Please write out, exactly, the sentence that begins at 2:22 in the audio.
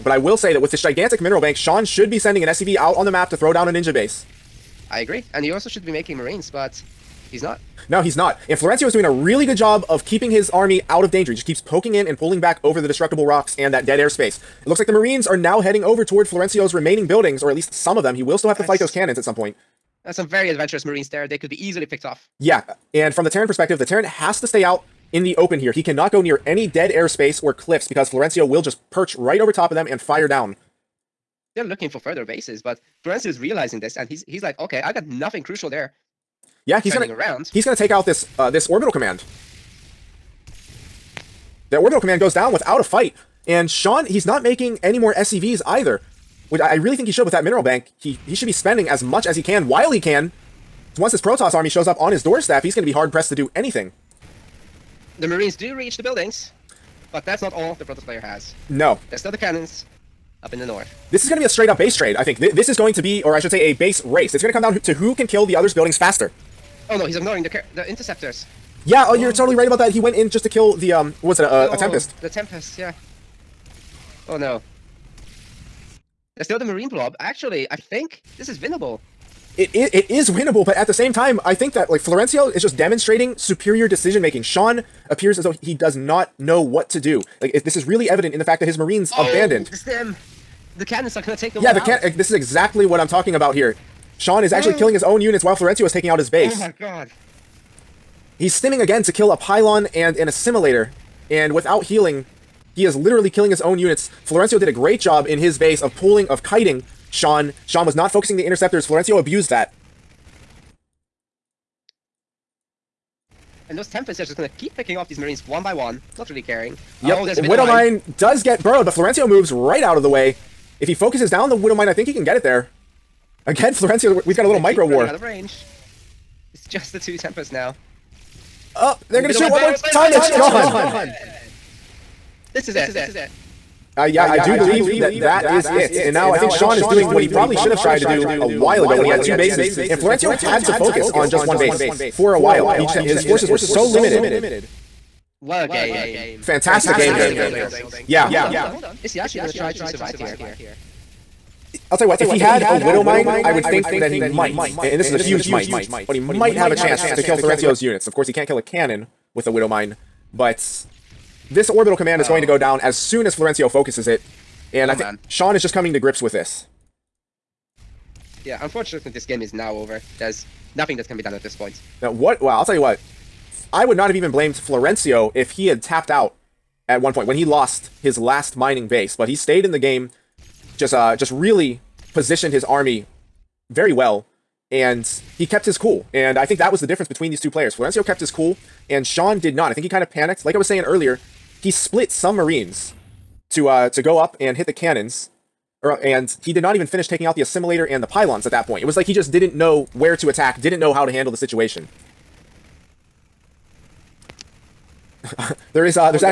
He just his forces were so limited.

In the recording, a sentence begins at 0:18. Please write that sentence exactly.
He will still have to That's...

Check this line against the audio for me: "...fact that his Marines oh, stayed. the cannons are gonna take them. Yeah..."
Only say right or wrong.
wrong.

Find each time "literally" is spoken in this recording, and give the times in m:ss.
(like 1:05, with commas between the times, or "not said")
1:42.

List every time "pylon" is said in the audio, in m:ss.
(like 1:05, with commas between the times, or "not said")
1:39, 3:18.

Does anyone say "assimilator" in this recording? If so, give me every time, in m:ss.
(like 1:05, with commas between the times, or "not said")
1:40, 3:17.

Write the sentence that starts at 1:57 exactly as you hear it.
Oh, Widowmine does get burrowed, but Florencio moves right out of the way.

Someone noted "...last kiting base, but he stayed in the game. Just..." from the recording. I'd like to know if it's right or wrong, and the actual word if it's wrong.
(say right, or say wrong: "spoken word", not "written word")
wrong: "mining", not "kiting".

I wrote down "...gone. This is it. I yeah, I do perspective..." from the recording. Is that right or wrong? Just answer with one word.
wrong.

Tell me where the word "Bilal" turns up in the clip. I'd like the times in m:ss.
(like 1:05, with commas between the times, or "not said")
not said.